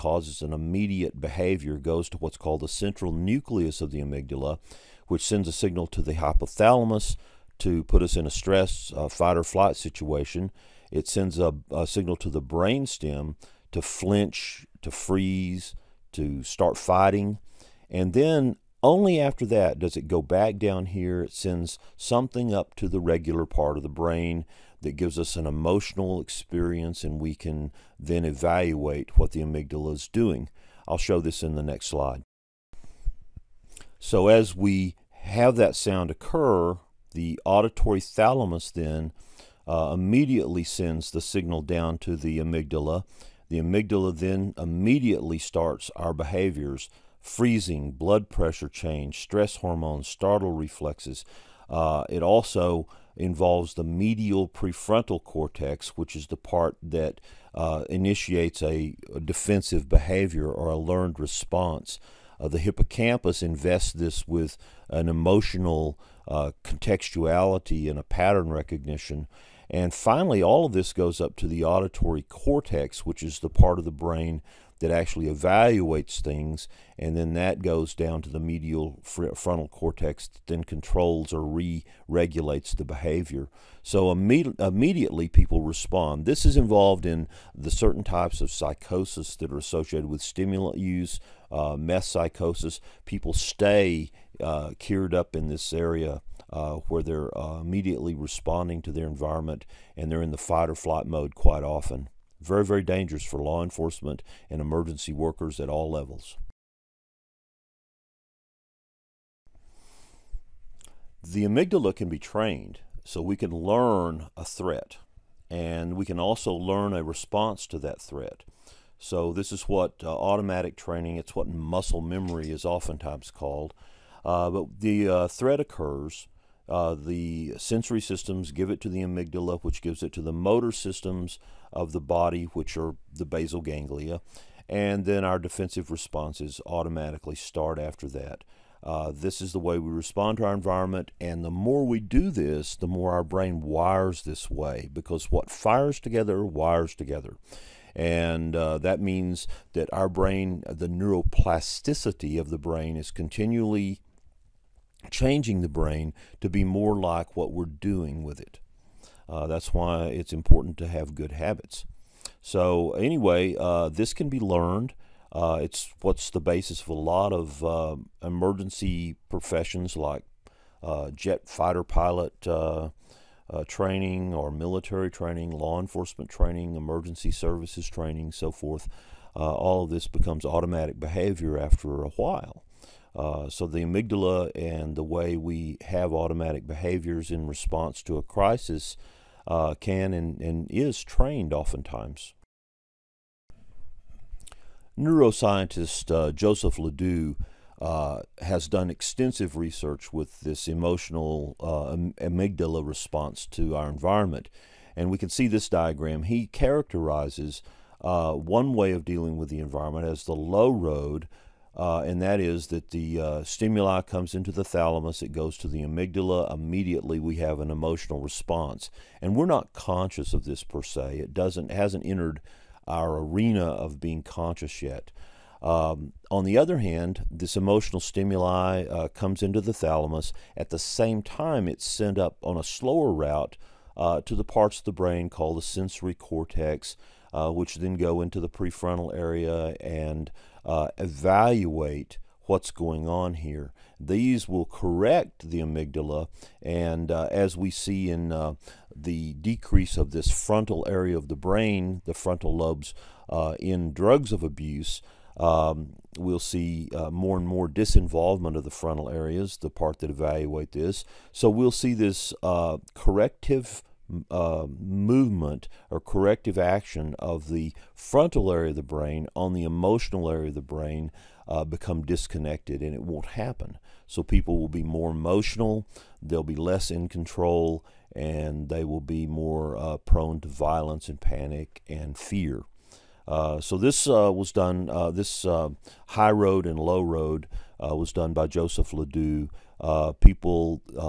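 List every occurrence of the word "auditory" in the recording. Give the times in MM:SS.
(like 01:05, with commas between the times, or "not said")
00:37, 01:11.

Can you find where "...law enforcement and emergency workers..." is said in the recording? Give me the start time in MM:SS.
01:43.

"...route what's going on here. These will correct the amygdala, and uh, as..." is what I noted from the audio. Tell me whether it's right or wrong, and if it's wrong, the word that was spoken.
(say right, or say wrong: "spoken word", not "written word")
wrong: "evaluate", not "route".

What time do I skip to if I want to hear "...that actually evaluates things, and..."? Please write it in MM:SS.
01:14.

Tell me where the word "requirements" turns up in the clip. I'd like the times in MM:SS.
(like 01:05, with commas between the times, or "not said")
not said.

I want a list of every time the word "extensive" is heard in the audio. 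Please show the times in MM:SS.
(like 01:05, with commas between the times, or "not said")
03:18.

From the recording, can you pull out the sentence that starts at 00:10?
It sends a, a signal to the brainstem to flinch, to freeze, to start fighting.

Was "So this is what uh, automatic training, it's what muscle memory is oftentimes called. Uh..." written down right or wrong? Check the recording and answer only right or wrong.
right.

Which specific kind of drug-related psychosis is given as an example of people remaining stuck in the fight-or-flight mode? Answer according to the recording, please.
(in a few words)
meth psychosis.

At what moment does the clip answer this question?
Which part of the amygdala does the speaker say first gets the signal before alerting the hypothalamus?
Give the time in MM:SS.
00:02.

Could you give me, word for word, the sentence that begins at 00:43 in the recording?
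The amygdala then immediately starts our behaviors freezing, blood pressure change, stress hormones, startle reflexes.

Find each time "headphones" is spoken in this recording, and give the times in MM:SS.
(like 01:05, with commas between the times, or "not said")
not said.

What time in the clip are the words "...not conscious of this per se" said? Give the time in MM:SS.
03:39.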